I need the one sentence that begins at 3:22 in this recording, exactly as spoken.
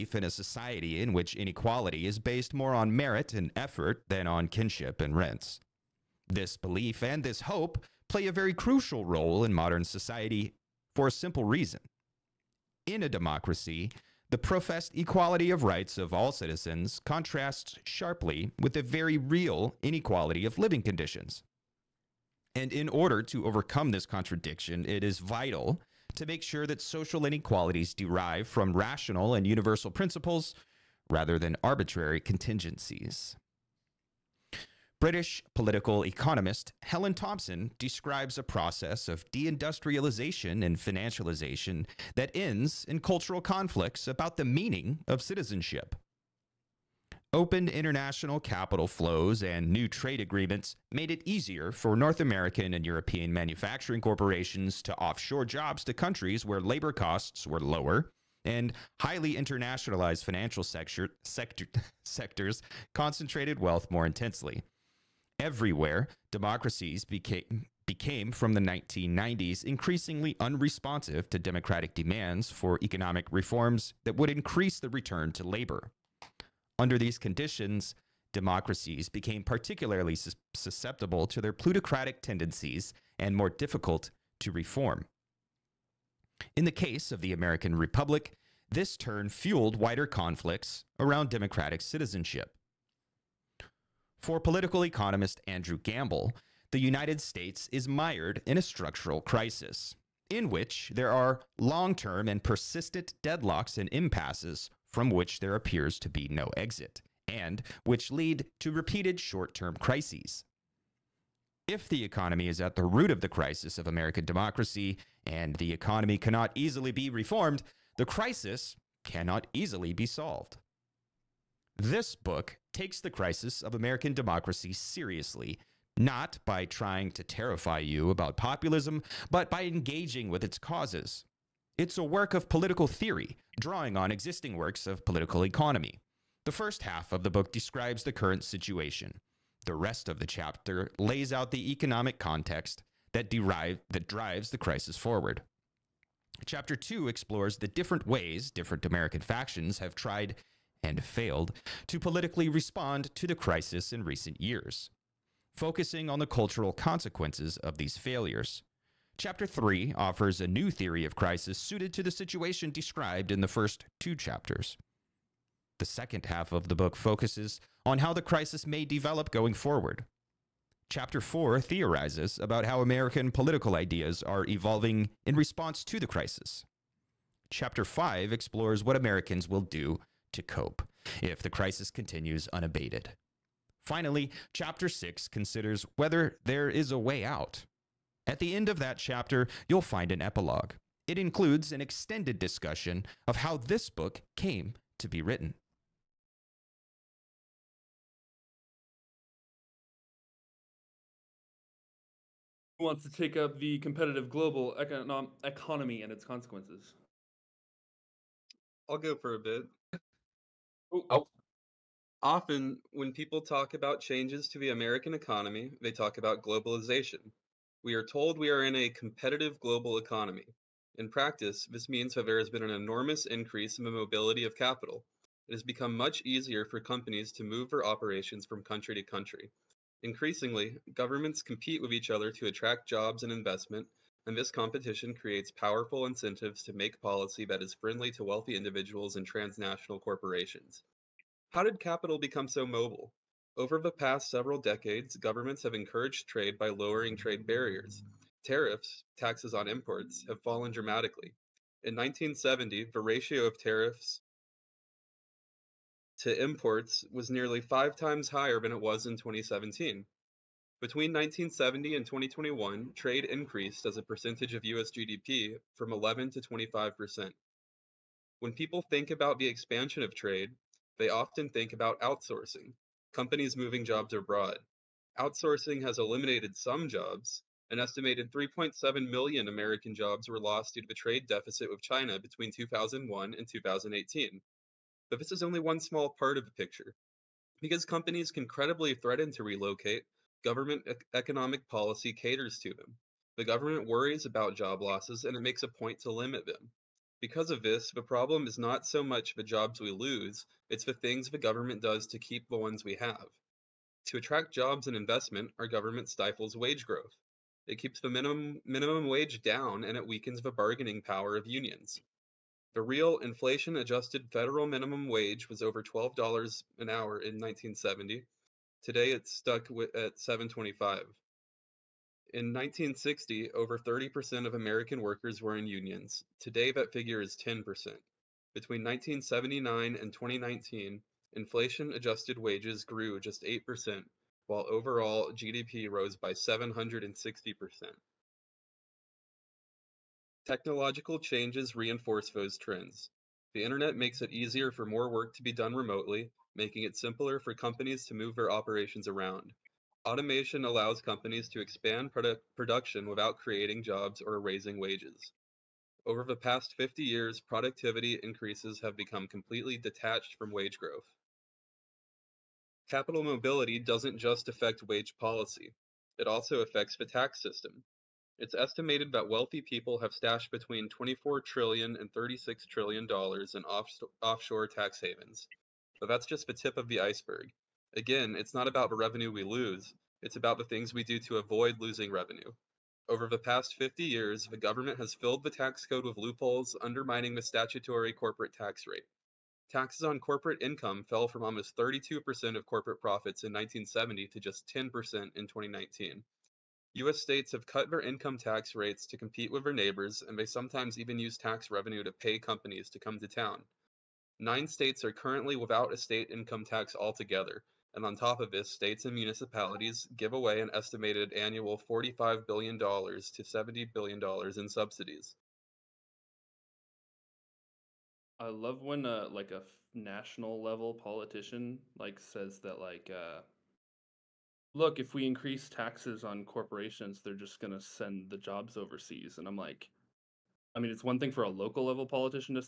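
Who wants to take up the competitive global economy and its consequences?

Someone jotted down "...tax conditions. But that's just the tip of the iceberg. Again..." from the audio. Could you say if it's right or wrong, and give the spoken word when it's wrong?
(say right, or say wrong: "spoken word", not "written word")
wrong: "havens", not "conditions".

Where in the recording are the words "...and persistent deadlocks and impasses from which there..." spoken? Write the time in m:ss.
1:42.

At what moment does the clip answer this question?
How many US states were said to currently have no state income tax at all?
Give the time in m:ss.
6:44.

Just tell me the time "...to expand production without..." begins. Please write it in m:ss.
5:51.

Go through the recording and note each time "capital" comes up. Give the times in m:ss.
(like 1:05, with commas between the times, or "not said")
0:48, 3:44, 4:01, 6:02.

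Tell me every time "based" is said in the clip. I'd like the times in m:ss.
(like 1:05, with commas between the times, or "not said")
0:02.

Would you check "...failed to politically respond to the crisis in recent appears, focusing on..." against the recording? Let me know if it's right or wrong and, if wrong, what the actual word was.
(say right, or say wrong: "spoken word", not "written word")
wrong: "years", not "appears".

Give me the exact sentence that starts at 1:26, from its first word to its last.
In the case of the American Republic, this turn fueled wider conflicts around democratic citizenship.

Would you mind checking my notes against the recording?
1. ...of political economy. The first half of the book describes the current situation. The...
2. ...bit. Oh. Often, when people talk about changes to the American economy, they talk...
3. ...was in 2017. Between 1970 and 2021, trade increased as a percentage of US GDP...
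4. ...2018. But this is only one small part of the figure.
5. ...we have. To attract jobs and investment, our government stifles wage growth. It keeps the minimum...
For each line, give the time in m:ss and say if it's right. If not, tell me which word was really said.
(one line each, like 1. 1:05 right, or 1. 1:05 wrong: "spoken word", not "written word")
1. 2:14 right
2. 3:29 right
3. 4:18 right
4. 4:43 wrong: "picture", not "figure"
5. 5:02 right.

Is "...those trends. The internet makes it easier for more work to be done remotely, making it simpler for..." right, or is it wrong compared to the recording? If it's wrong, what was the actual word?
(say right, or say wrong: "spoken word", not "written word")
right.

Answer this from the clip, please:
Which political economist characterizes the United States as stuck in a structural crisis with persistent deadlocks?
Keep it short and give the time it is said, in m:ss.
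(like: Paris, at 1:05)
Andrew Gamble, at 1:35.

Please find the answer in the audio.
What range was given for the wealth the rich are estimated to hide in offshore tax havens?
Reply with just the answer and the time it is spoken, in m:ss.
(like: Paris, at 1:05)
$24-36 trillion, at 6:10.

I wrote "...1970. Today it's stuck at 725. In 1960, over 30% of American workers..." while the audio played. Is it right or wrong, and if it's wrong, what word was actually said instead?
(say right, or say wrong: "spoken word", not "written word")
right.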